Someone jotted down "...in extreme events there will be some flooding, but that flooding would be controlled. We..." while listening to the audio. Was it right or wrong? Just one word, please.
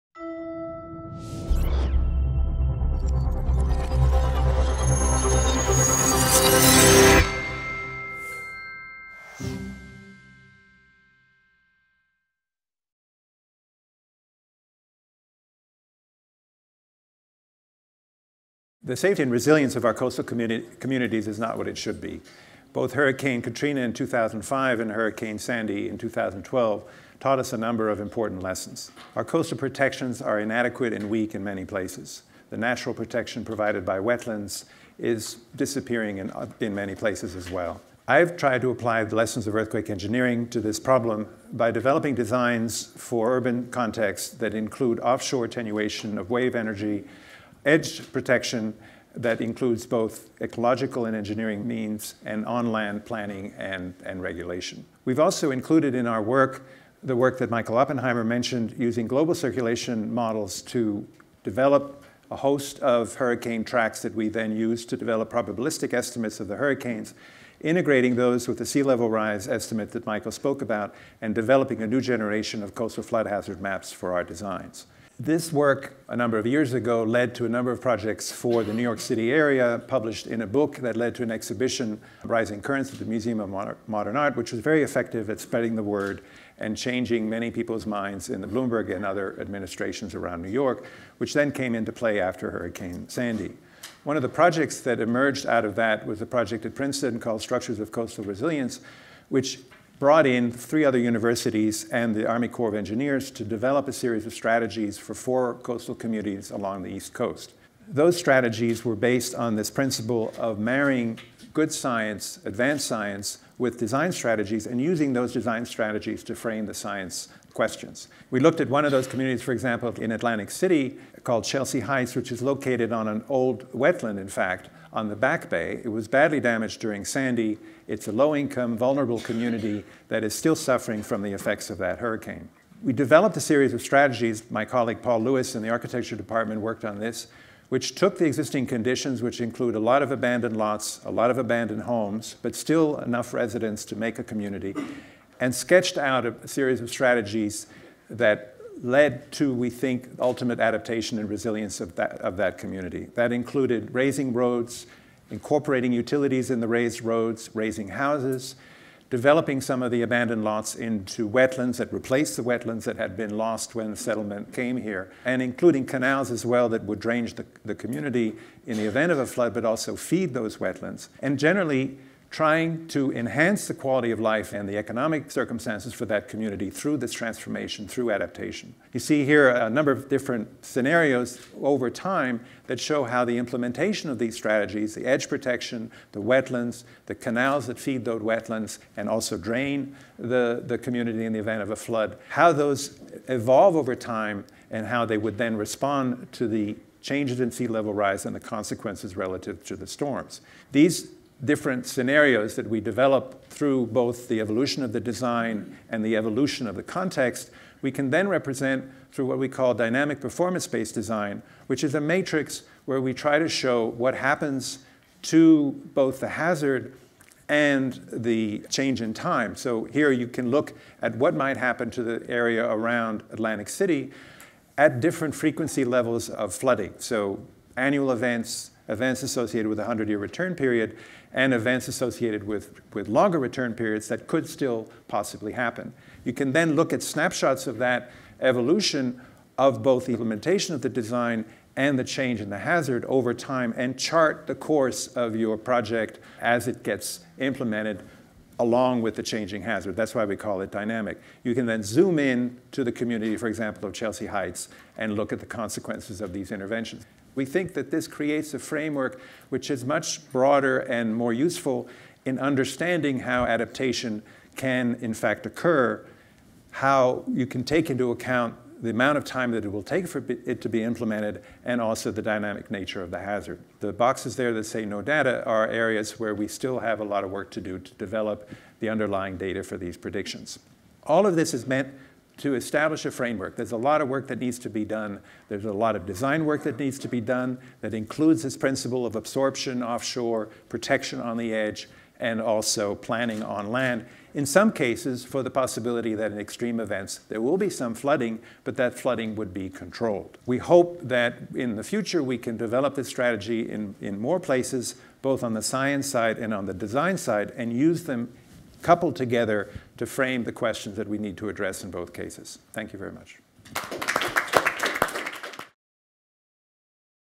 right.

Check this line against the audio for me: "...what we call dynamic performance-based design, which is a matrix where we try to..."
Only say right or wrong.
right.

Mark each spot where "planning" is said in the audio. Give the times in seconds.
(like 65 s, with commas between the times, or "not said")
53 s, 292 s.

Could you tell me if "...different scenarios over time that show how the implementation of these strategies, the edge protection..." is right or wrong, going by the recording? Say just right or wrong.
right.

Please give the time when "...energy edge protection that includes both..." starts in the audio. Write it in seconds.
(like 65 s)
46 s.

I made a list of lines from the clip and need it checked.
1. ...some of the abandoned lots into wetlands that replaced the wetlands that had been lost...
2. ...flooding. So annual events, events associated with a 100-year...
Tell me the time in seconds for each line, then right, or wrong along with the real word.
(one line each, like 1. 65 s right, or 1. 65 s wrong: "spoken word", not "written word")
1. 159 s right
2. 226 s right.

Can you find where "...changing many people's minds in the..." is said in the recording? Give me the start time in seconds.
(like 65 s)
86 s.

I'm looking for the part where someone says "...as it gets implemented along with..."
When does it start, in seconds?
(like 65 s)
246 s.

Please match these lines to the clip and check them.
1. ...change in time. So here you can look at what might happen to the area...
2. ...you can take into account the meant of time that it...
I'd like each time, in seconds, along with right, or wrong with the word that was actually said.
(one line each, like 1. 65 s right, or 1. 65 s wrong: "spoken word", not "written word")
1. 218 s right
2. 267 s wrong: "amount", not "meant".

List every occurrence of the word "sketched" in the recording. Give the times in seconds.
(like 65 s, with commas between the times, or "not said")
145 s.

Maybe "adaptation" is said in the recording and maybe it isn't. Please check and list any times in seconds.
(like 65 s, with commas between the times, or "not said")
150 s, 178 s, 263 s.